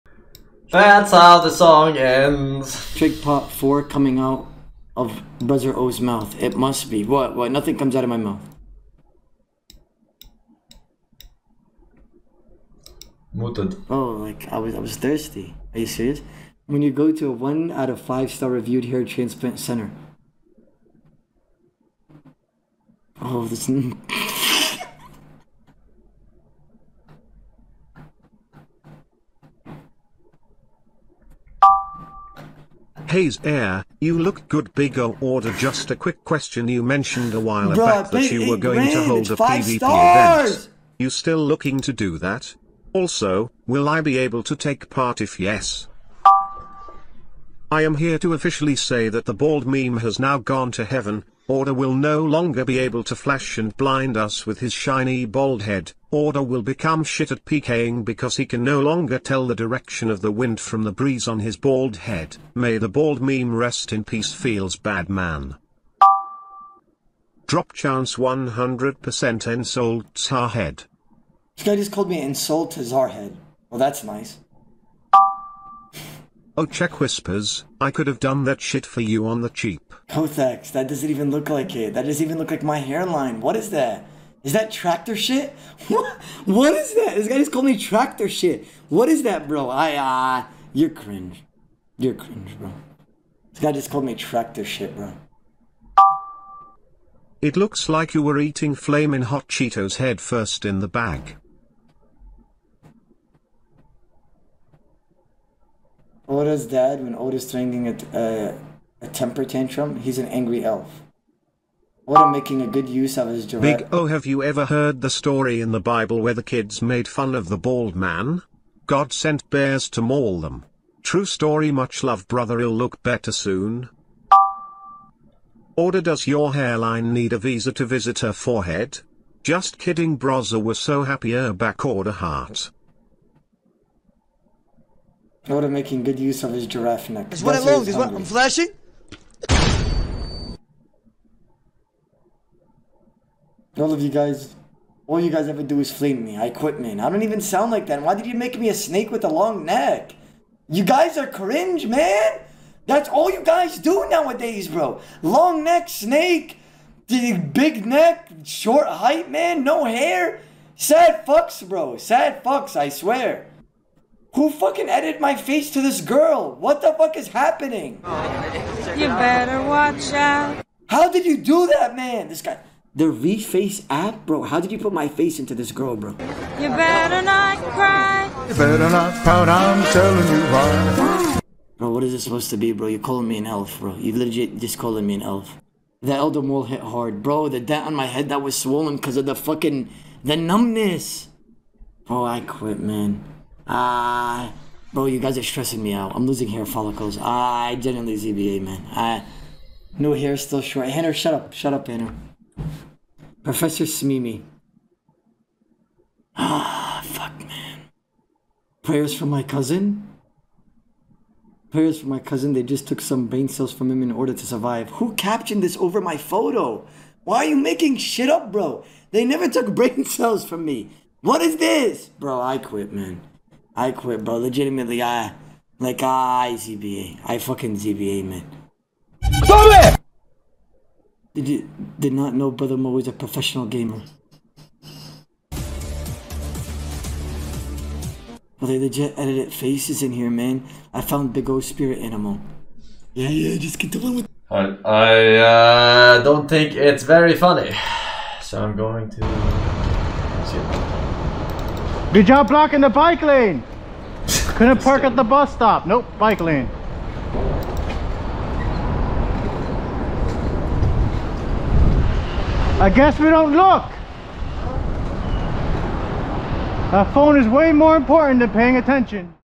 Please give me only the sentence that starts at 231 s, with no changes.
Did you did not know Brother Mo is a professional gamer?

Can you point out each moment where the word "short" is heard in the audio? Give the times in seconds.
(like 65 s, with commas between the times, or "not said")
158 s, 200 s.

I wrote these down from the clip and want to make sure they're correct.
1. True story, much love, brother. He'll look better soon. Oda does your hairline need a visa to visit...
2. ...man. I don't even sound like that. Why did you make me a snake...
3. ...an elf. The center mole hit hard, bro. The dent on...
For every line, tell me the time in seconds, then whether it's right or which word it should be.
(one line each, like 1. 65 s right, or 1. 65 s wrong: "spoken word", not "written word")
1. 121 s right
2. 146 s right
3. 185 s wrong: "elder", not "center".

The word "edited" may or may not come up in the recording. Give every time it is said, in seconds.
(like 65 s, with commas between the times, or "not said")
164 s, 239 s.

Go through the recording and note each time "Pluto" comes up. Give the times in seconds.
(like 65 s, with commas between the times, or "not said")
not said.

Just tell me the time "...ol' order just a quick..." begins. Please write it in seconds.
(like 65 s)
34 s.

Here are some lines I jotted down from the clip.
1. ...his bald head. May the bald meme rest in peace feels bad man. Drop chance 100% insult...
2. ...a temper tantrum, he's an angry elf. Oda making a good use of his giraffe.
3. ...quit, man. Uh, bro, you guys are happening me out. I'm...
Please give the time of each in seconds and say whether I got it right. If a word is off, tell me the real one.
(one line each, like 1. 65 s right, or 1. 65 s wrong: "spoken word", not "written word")
1. 61 s right
2. 109 s right
3. 192 s wrong: "stressing", not "happening".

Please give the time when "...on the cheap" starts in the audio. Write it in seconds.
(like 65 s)
79 s.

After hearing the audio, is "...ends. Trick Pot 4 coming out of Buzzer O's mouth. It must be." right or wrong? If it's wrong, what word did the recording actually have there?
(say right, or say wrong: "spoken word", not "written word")
right.